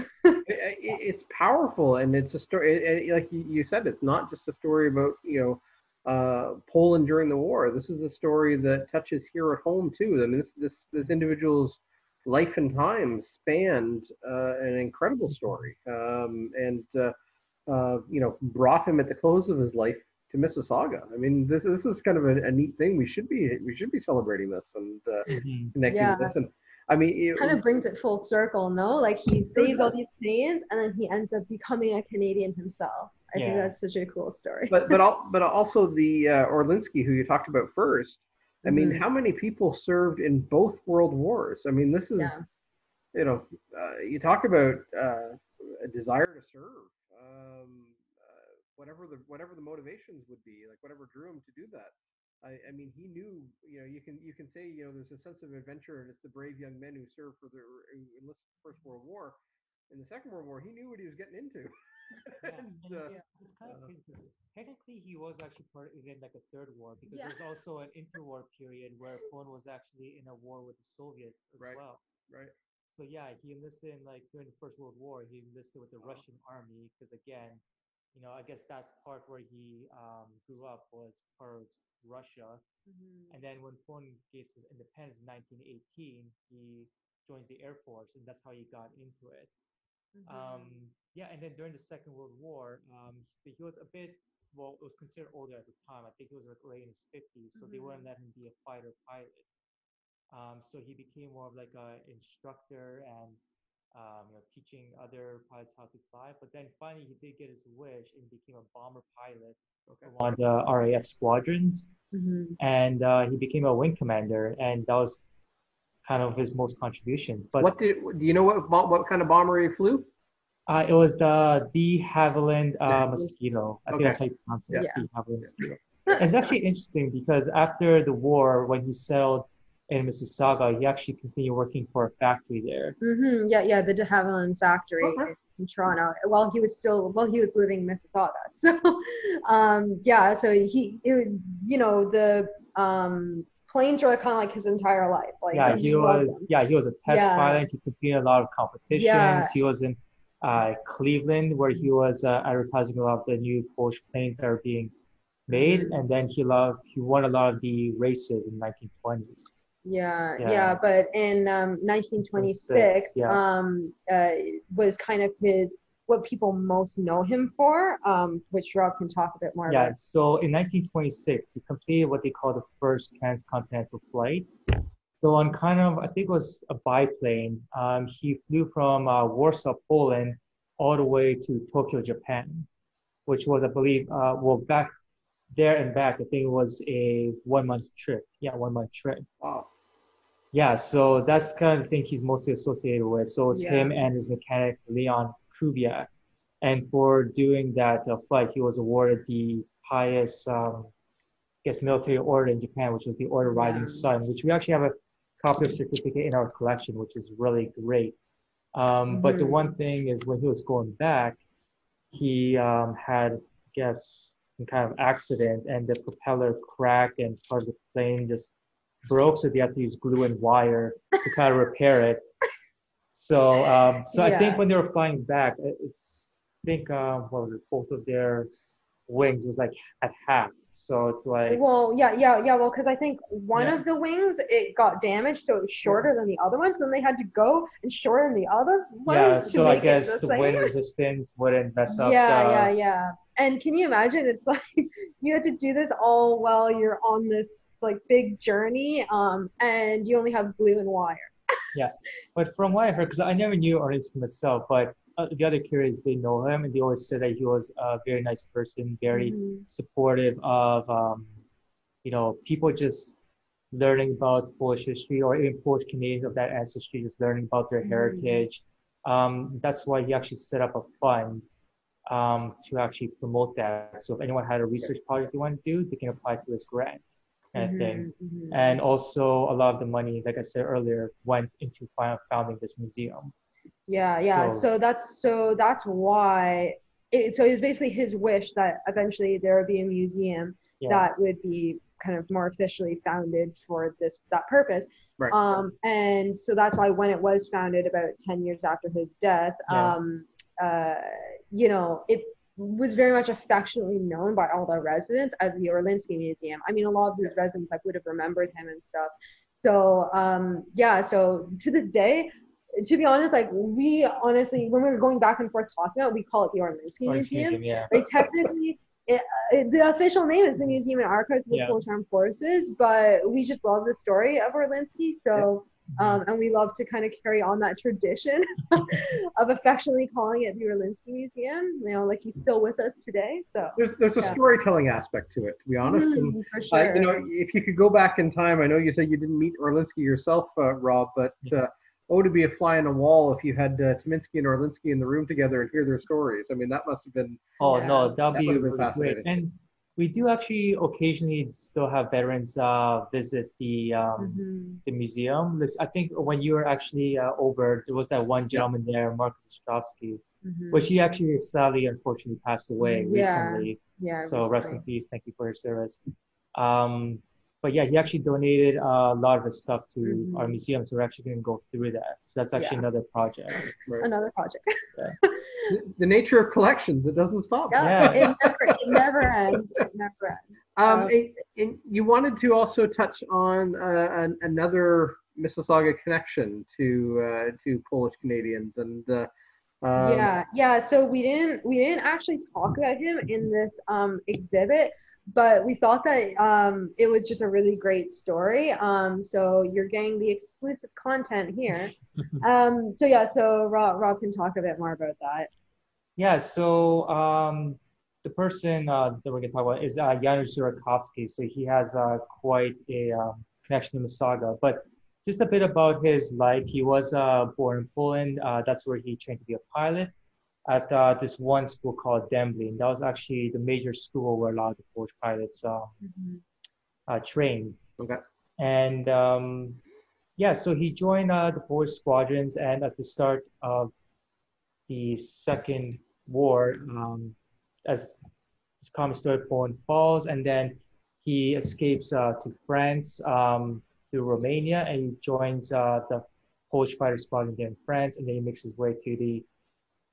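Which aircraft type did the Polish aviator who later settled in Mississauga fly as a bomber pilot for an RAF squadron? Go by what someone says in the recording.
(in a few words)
De Havilland Mosquito.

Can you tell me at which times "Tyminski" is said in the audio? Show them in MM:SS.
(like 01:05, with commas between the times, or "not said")
05:43.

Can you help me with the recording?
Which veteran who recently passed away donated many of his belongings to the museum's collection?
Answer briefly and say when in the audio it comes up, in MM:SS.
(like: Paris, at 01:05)
Marcus Ostrowski, at 05:59.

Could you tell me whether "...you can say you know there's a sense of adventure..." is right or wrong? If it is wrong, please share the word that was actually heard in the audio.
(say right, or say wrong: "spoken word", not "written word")
right.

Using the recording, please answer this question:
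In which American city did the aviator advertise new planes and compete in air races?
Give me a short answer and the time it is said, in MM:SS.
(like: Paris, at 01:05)
Cleveland, at 02:30.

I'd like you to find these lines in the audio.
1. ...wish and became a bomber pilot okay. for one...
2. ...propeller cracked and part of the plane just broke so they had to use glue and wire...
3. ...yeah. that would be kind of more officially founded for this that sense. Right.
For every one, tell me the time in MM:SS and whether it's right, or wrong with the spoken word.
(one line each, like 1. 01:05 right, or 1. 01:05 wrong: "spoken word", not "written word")
1. 01:47 right
2. 03:36 right
3. 04:50 wrong: "purpose", not "sense".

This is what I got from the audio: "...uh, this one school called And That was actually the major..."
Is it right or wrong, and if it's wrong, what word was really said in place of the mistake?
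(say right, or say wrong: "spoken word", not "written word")
right.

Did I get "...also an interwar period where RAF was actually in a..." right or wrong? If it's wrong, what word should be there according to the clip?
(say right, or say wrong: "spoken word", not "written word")
wrong: "Poland", not "RAF".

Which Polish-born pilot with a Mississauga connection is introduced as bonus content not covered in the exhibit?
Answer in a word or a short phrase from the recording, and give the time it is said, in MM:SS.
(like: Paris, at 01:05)
Janusz Zurakowski, at 06:50.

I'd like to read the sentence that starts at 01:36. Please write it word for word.
I think he was like late in his 50s, so mm-hmm.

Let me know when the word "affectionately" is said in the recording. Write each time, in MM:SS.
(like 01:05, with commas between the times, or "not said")
05:03, 05:29.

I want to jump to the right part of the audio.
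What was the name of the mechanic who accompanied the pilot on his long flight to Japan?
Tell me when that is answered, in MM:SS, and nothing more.
03:14.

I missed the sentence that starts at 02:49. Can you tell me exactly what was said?
so in 1926, he completed what they call the first transcontinental flight.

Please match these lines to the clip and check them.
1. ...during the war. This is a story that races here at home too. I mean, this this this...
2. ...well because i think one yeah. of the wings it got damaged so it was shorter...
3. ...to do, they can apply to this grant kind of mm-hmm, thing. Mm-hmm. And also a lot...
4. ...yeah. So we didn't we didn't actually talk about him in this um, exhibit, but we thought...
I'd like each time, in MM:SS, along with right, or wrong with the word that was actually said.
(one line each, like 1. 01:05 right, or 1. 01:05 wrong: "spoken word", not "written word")
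1. 00:07 wrong: "touches", not "races"
2. 03:52 right
3. 04:35 right
4. 06:30 right.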